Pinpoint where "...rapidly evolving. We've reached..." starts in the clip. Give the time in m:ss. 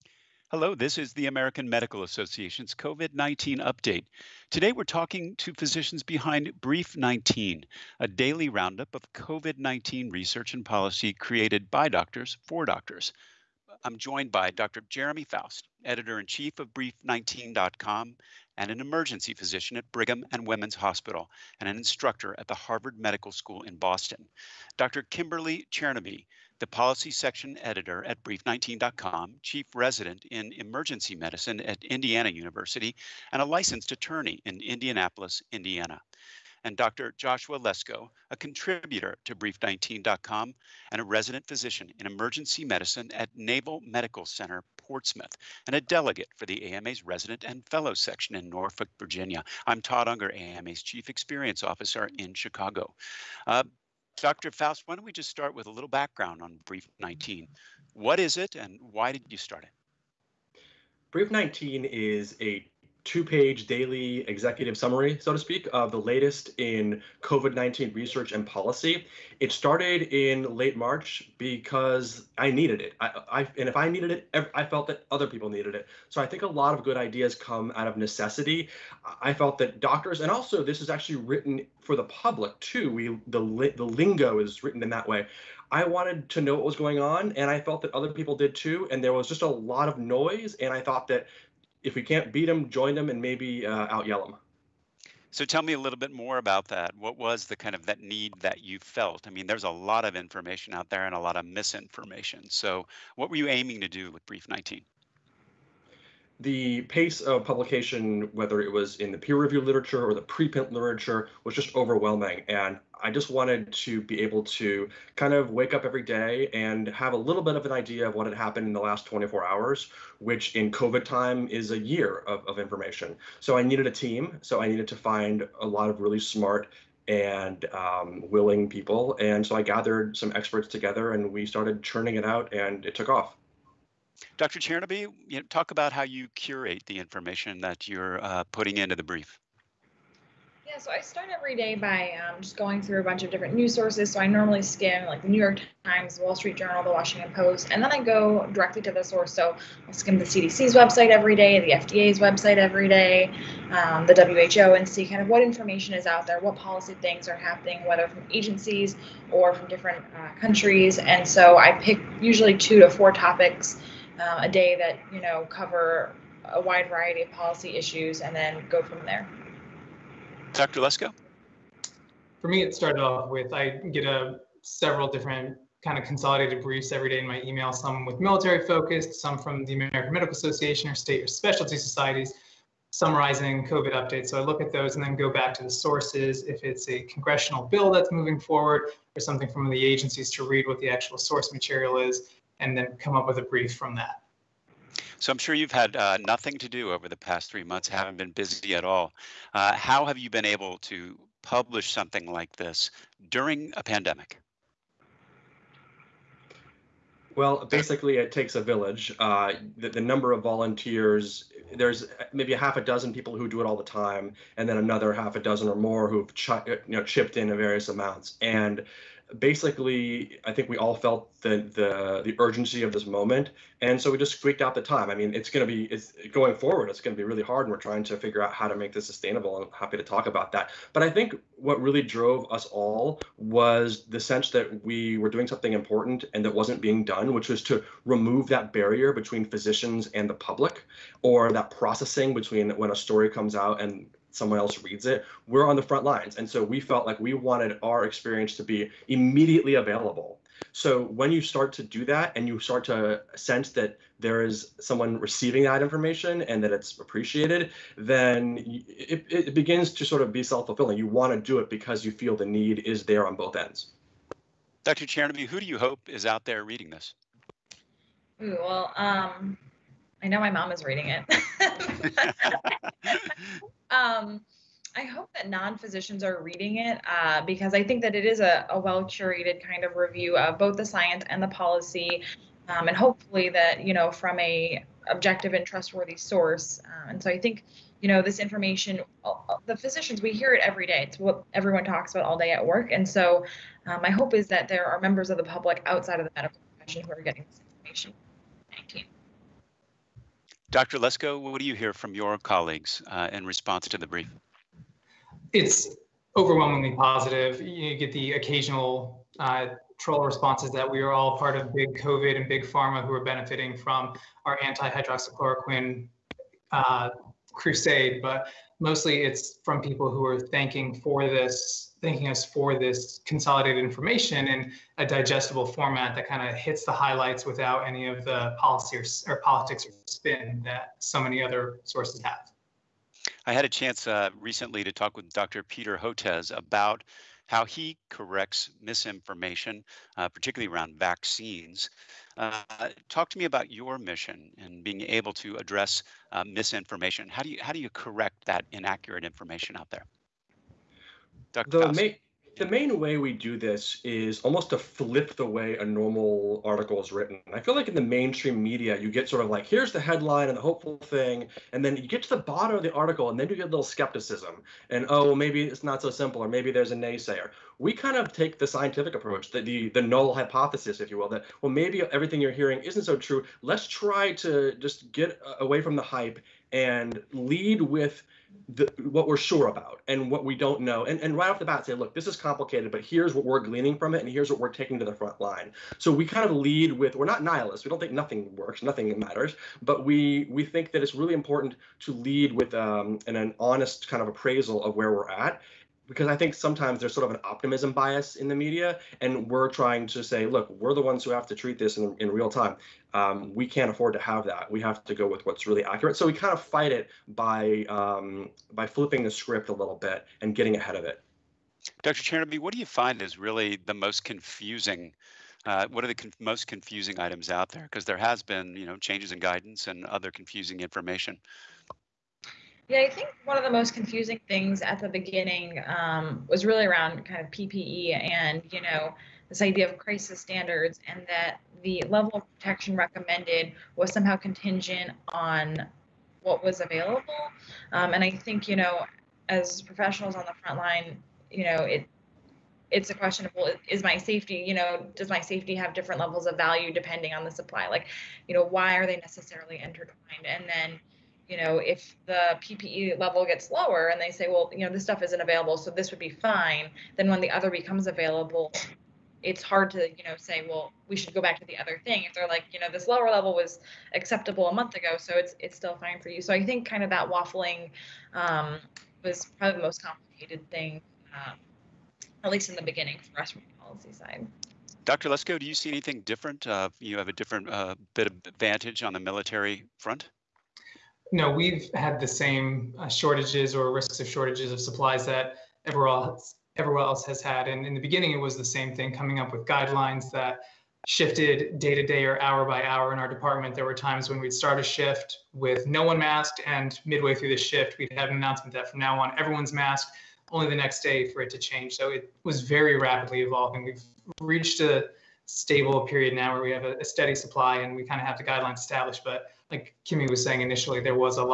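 8:22.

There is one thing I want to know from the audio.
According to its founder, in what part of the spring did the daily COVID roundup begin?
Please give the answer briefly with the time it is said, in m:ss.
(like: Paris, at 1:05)
late March, at 1:10.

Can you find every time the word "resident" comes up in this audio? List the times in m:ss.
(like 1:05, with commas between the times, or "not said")
0:29, 0:41, 0:47.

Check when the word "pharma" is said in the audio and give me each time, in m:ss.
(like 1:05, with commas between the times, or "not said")
5:12.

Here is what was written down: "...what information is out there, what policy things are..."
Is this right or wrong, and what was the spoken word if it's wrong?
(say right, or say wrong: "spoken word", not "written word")
right.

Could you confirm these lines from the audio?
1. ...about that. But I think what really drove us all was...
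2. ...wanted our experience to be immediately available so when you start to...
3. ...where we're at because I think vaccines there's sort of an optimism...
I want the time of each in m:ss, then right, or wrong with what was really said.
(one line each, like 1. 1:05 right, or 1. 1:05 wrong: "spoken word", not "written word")
1. 3:50 right
2. 4:07 right
3. 6:34 wrong: "sometimes", not "vaccines".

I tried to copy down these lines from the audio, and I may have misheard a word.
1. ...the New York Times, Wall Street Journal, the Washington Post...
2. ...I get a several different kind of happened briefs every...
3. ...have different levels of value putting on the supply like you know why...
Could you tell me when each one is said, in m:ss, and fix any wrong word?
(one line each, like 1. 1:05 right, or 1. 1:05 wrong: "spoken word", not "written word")
1. 2:25 right
2. 2:53 wrong: "consolidated", not "happened"
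3. 7:25 wrong: "depending", not "putting".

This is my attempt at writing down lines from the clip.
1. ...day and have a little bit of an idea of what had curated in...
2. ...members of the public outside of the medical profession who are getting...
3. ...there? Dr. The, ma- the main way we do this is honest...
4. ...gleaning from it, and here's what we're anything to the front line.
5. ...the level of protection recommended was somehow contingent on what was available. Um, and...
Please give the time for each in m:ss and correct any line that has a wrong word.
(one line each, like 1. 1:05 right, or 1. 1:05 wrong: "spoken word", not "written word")
1. 1:56 wrong: "happened", not "curated"
2. 4:55 right
3. 5:49 wrong: "almost", not "honest"
4. 6:23 wrong: "taking", not "anything"
5. 7:11 right.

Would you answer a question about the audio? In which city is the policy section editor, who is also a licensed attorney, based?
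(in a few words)
Indianapolis.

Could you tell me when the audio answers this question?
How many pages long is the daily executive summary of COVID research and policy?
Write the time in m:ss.
1:03.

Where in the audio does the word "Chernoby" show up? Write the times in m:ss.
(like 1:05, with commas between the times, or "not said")
0:25, 2:14, 4:25, 6:52.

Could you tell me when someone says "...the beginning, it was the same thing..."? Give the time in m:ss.
8:07.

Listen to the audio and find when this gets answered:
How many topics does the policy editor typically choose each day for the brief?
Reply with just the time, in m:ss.
2:42.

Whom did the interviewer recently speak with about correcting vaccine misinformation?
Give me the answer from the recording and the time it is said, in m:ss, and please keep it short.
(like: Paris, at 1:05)
Peter Hotez, at 5:35.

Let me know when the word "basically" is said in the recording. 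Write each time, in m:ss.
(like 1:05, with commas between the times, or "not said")
3:27, 3:39.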